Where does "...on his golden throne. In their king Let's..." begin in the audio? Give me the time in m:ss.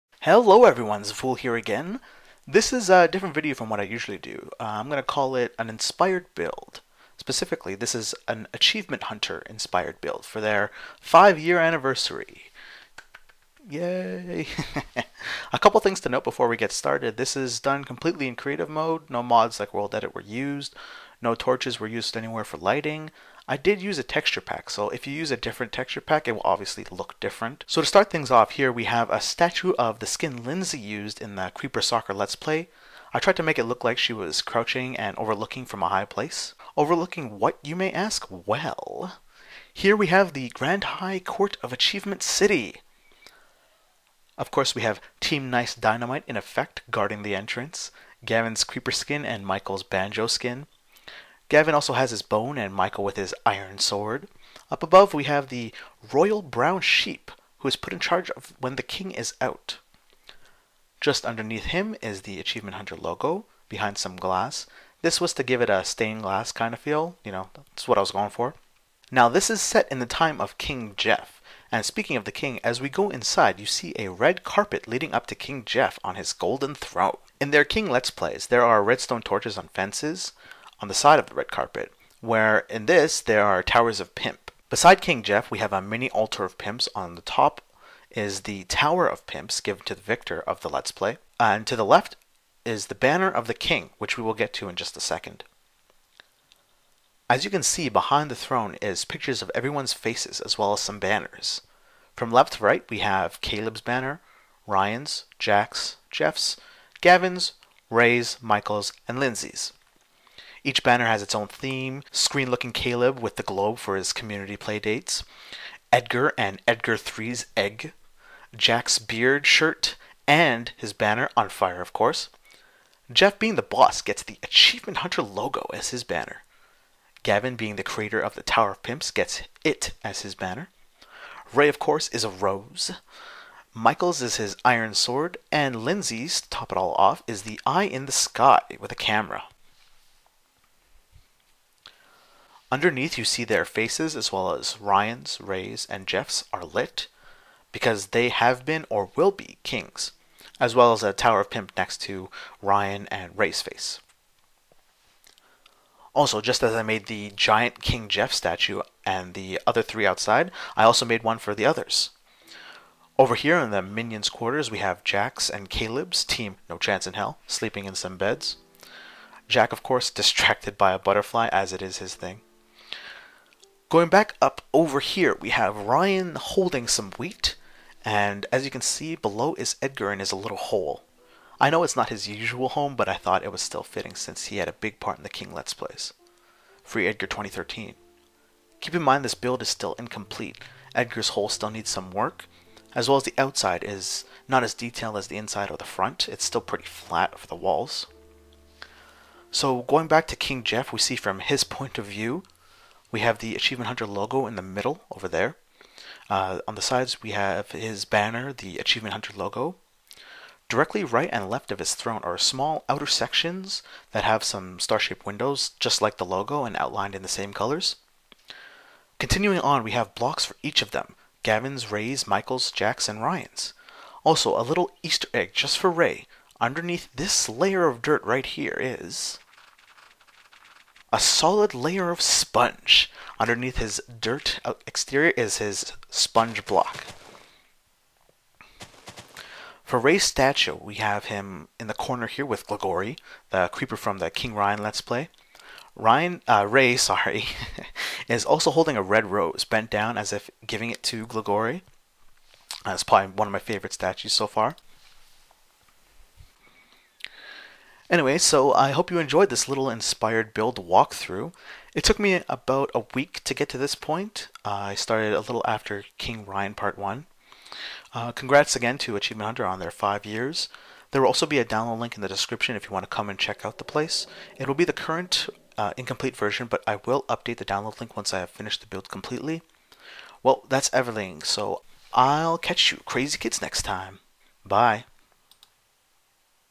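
1:16.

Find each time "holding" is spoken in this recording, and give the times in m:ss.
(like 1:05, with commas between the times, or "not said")
2:56, 4:08.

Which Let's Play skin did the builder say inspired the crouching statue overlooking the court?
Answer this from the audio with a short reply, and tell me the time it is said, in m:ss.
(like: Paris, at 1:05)
Creeper Soccer, at 0:31.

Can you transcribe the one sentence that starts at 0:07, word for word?
Specifically, this is an Achievement Hunter inspired build for their five-year anniversary.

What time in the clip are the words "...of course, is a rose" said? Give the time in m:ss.
2:11.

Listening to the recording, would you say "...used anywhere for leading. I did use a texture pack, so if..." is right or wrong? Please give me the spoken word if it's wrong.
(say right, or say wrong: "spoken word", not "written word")
wrong: "lighting", not "leading".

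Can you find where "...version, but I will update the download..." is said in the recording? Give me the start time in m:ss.
4:36.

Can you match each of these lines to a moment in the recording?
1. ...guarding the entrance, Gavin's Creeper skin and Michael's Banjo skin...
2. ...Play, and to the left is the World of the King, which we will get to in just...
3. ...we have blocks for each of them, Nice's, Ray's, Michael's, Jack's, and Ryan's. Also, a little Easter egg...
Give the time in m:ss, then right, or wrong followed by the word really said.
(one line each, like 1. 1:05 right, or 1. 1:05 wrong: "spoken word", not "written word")
1. 0:46 right
2. 1:30 wrong: "Banner", not "World"
3. 3:39 wrong: "Gavin", not "Nice".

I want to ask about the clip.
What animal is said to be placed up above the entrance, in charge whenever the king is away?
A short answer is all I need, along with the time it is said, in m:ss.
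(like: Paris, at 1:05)
Royal brown sheep, at 0:56.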